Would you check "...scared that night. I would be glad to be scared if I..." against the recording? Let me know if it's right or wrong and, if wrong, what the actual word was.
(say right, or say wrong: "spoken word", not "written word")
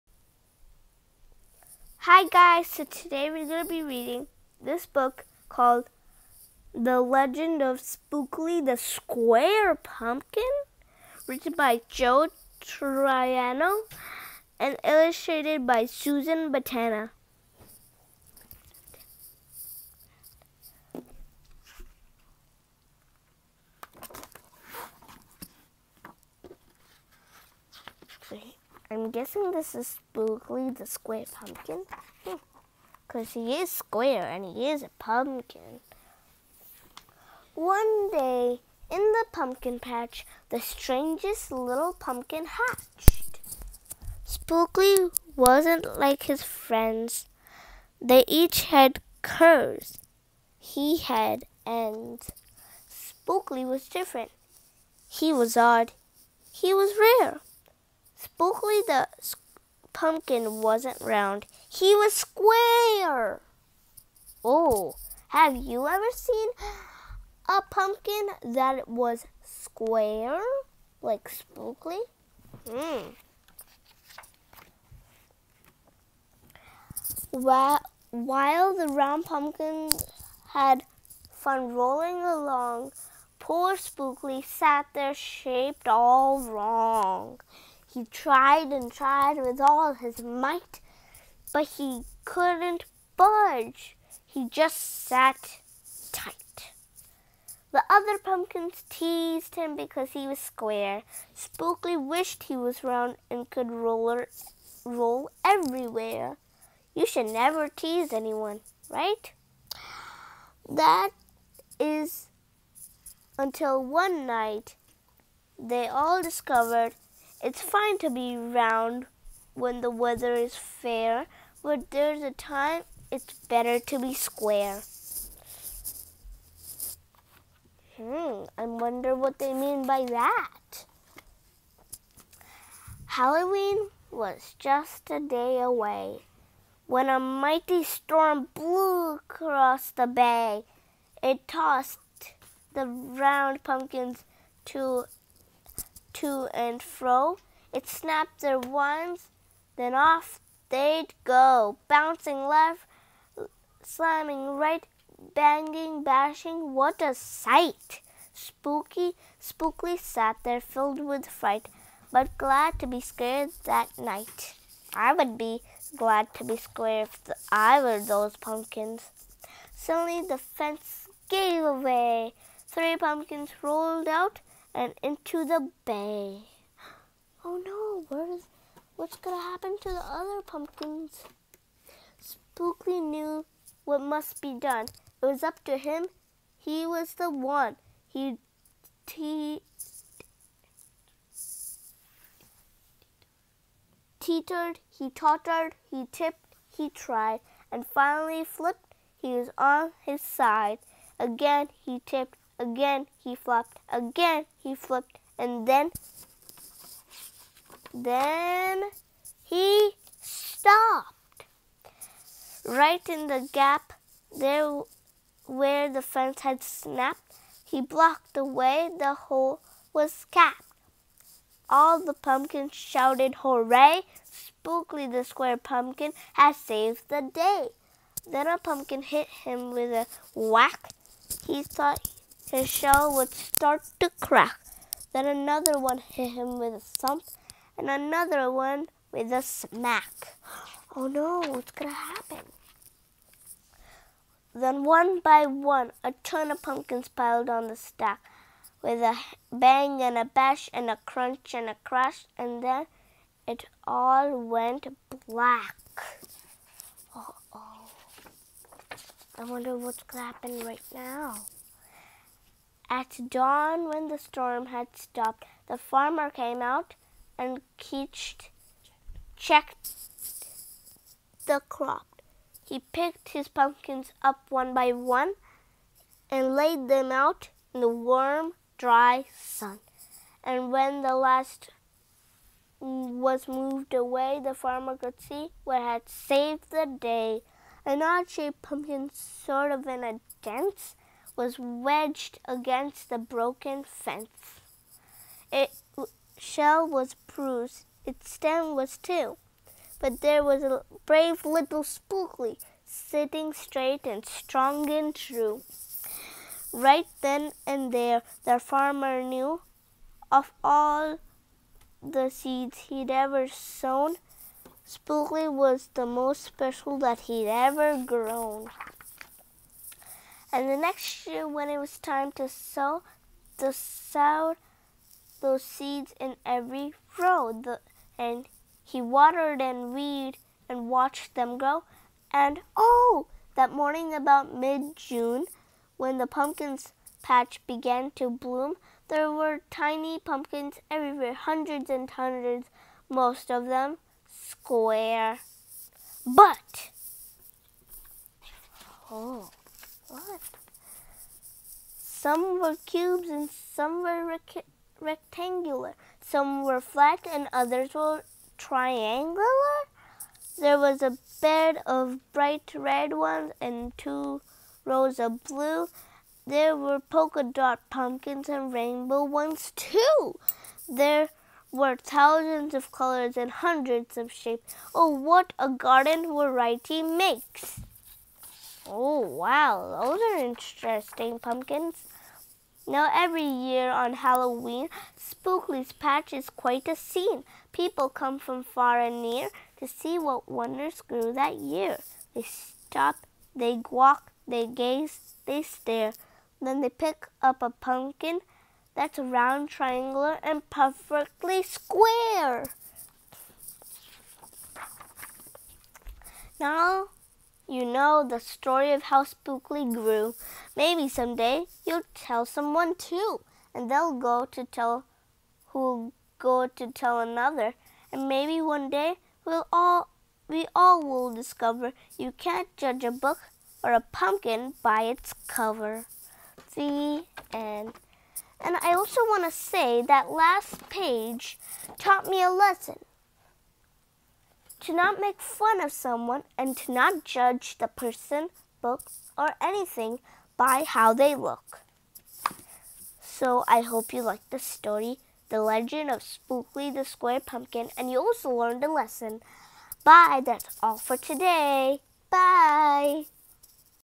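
right.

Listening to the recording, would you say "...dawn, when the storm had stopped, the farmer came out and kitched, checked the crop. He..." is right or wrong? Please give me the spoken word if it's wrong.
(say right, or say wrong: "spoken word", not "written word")
right.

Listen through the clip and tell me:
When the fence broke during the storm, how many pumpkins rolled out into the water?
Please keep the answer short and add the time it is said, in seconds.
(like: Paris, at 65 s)
3, at 172 s.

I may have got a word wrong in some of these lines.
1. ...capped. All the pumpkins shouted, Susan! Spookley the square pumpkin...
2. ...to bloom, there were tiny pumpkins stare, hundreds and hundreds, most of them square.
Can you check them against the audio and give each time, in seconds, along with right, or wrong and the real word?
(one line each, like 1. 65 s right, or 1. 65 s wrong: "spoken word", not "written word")
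1. 220 s wrong: "Hooray", not "Susan"
2. 338 s wrong: "everywhere", not "stare".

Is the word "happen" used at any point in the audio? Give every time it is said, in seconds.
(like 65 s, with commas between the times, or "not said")
179 s, 241 s, 260 s.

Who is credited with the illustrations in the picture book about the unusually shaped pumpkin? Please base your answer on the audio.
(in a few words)
Susan Banta.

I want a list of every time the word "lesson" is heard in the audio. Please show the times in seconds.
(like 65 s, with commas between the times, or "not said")
432 s, 448 s.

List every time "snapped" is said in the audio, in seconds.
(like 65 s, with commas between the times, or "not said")
147 s, 216 s.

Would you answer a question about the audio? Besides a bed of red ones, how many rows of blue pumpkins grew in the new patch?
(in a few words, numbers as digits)
2.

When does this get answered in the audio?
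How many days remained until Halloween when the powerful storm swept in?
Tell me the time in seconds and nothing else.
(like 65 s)
135 s.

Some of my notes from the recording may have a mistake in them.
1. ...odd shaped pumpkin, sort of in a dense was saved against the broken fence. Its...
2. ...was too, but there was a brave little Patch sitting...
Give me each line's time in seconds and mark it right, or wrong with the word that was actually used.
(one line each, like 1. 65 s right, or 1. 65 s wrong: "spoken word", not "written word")
1. 288 s wrong: "wedged", not "saved"
2. 298 s wrong: "Spookley", not "Patch".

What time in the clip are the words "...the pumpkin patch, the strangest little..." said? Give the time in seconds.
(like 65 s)
39 s.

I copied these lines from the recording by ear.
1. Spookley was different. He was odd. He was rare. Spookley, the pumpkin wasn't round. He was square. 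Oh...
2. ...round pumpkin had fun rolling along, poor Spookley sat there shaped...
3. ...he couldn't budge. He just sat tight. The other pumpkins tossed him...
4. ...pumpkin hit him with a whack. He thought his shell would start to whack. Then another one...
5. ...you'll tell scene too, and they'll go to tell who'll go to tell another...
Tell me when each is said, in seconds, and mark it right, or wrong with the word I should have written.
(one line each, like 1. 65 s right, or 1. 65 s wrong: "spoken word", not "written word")
1. 52 s right
2. 78 s right
3. 91 s wrong: "teased", not "tossed"
4. 228 s wrong: "crack", not "whack"
5. 411 s wrong: "someone", not "scene".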